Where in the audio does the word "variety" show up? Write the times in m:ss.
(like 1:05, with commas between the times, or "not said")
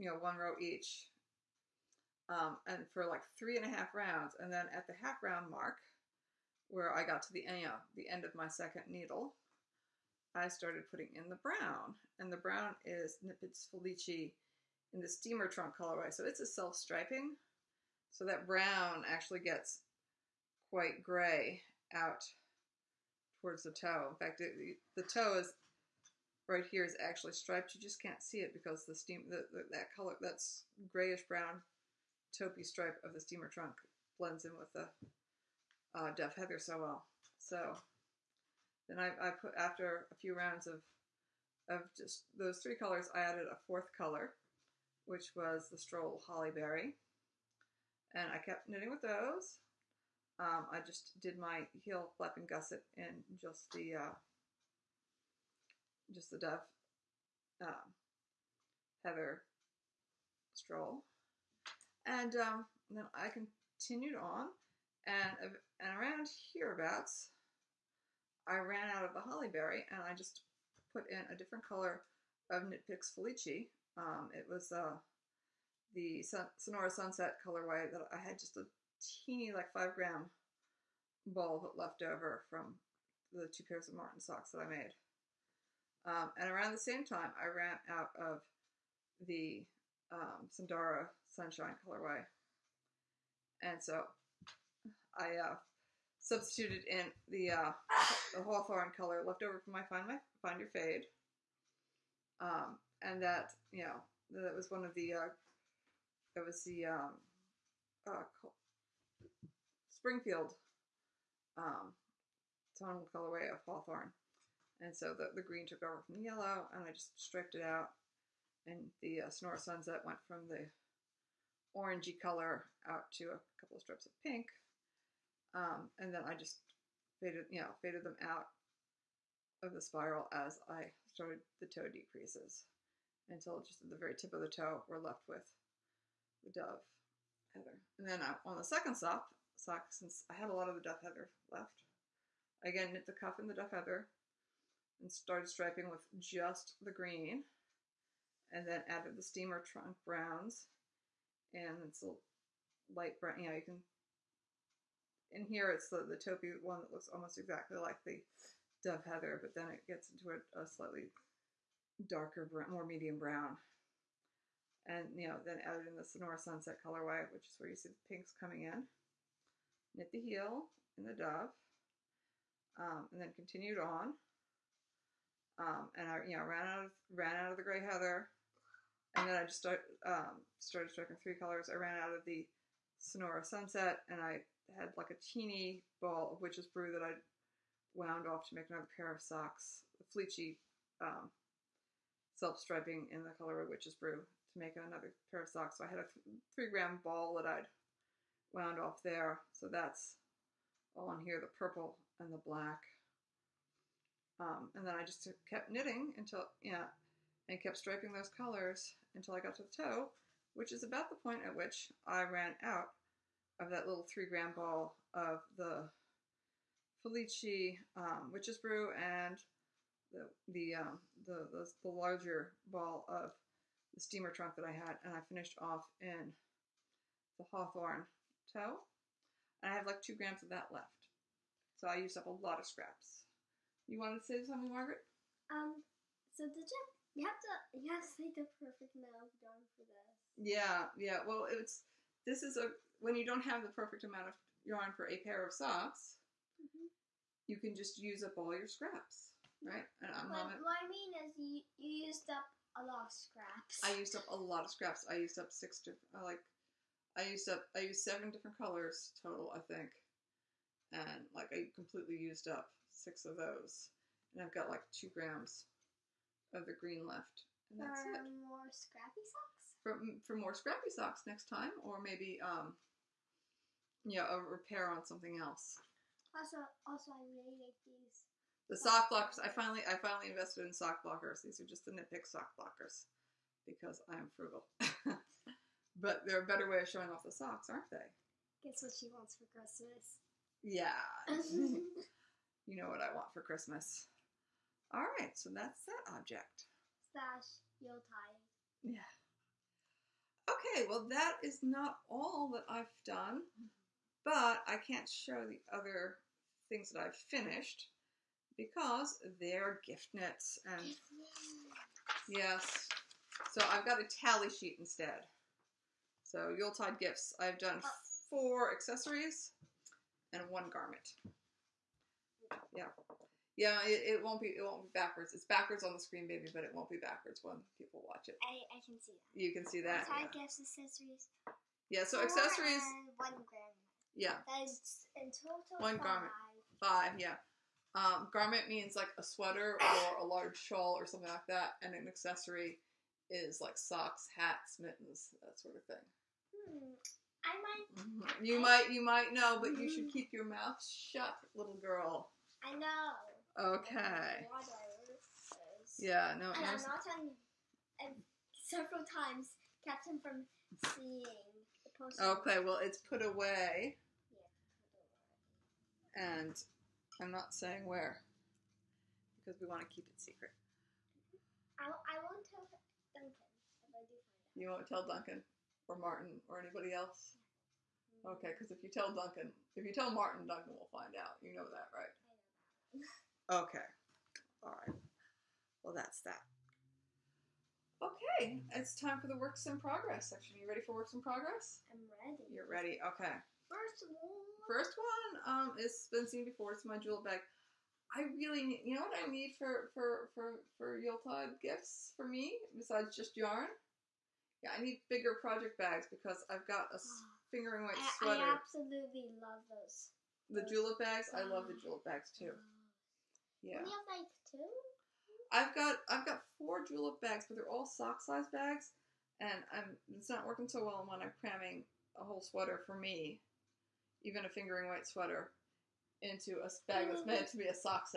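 not said.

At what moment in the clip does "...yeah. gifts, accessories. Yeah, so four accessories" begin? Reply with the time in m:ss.
5:30.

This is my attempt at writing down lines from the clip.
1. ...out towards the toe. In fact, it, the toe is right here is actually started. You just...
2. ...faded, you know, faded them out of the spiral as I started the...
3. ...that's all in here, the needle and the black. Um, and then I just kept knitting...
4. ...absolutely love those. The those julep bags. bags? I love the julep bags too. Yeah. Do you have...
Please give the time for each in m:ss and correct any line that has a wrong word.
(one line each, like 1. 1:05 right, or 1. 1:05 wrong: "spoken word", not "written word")
1. 0:21 wrong: "striped", not "started"
2. 2:07 right
3. 3:19 wrong: "purple", not "needle"
4. 6:48 right.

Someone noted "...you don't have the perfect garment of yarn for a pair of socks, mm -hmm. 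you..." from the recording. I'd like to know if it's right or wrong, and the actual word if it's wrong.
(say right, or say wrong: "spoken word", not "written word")
wrong: "amount", not "garment".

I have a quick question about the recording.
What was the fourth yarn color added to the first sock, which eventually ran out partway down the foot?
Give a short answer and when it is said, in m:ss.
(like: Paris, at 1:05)
Stroll Holly Berry, at 0:45.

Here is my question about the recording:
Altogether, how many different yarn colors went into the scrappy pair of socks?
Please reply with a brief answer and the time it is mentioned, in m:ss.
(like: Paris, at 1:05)
7, at 4:18.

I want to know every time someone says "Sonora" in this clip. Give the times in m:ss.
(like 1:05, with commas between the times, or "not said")
1:16, 1:59, 2:46, 3:02.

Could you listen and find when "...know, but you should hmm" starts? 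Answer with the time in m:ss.
5:49.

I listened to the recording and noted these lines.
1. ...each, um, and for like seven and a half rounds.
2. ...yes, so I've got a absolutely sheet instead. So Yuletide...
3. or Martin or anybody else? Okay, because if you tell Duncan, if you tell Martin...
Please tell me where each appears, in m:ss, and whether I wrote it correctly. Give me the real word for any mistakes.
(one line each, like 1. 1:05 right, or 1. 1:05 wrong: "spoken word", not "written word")
1. 0:00 wrong: "three", not "seven"
2. 5:12 wrong: "tally", not "absolutely"
3. 6:15 right.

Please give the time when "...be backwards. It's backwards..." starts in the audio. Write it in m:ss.
5:24.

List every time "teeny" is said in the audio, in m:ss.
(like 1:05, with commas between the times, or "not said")
1:19, 3:05.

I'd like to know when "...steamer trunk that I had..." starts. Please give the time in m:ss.
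3:43.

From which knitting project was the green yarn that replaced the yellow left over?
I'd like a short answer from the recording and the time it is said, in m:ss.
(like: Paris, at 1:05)
Find Your Fade, at 1:40.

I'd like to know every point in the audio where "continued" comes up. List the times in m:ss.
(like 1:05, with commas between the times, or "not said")
1:03, 2:53.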